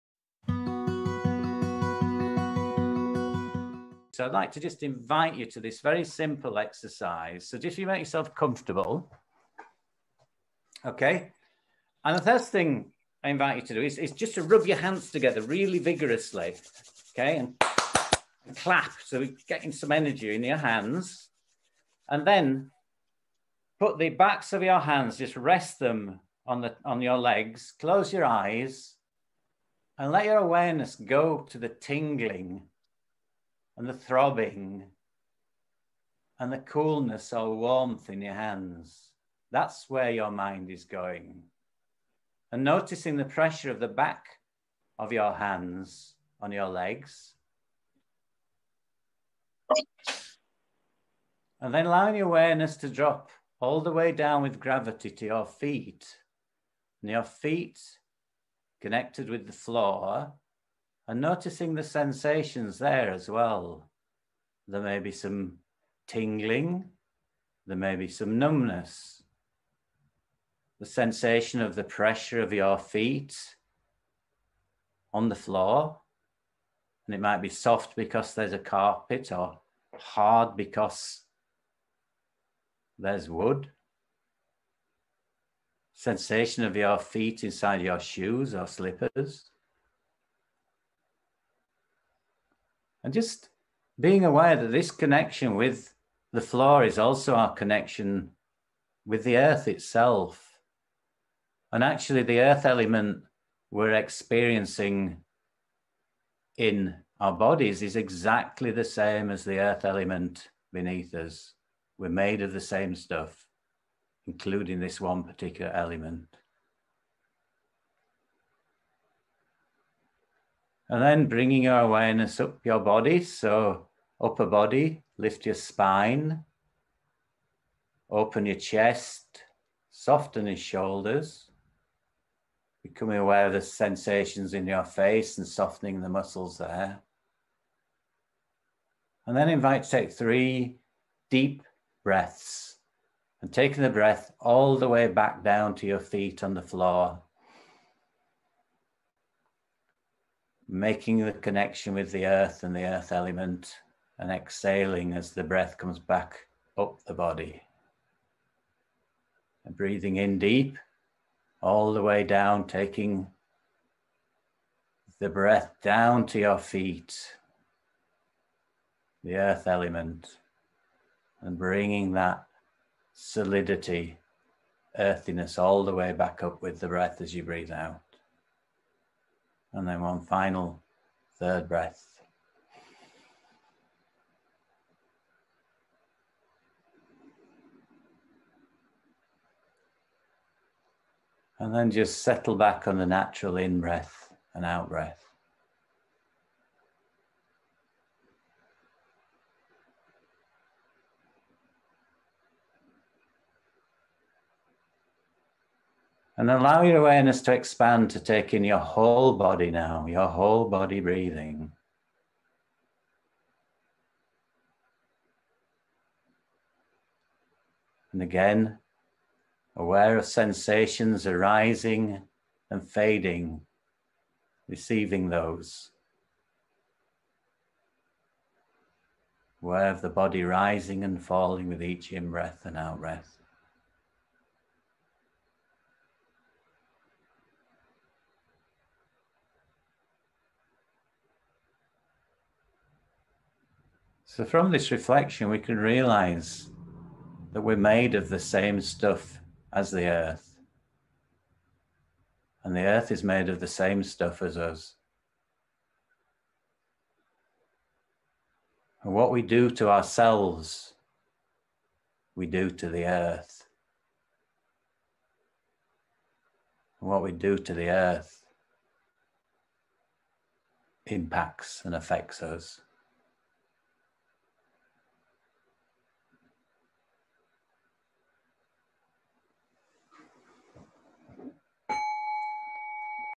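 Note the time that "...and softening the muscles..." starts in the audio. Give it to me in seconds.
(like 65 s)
135 s.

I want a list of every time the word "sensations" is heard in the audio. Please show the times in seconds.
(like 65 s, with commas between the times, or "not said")
61 s, 70 s, 85 s, 133 s, 220 s.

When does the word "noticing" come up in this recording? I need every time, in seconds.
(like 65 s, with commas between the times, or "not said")
42 s, 61 s.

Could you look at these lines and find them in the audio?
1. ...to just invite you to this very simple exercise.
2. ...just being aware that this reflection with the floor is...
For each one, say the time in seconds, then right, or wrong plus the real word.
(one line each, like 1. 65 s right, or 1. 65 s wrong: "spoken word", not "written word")
1. 4 s right
2. 93 s wrong: "connection", not "reflection".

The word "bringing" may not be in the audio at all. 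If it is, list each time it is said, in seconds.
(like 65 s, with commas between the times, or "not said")
121 s, 171 s.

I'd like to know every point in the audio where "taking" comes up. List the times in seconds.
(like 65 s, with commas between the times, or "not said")
143 s, 162 s.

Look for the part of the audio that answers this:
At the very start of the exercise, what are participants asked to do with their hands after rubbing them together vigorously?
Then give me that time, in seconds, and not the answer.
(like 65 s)
18 s.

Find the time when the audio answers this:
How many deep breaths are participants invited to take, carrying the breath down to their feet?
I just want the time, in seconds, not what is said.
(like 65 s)
140 s.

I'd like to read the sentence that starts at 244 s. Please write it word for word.
So, from this reflection, we can realize that we're made of the same stuff as the earth.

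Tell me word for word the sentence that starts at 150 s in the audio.
making the connection with the earth and the earth element, and exhaling as the breath comes back up the body.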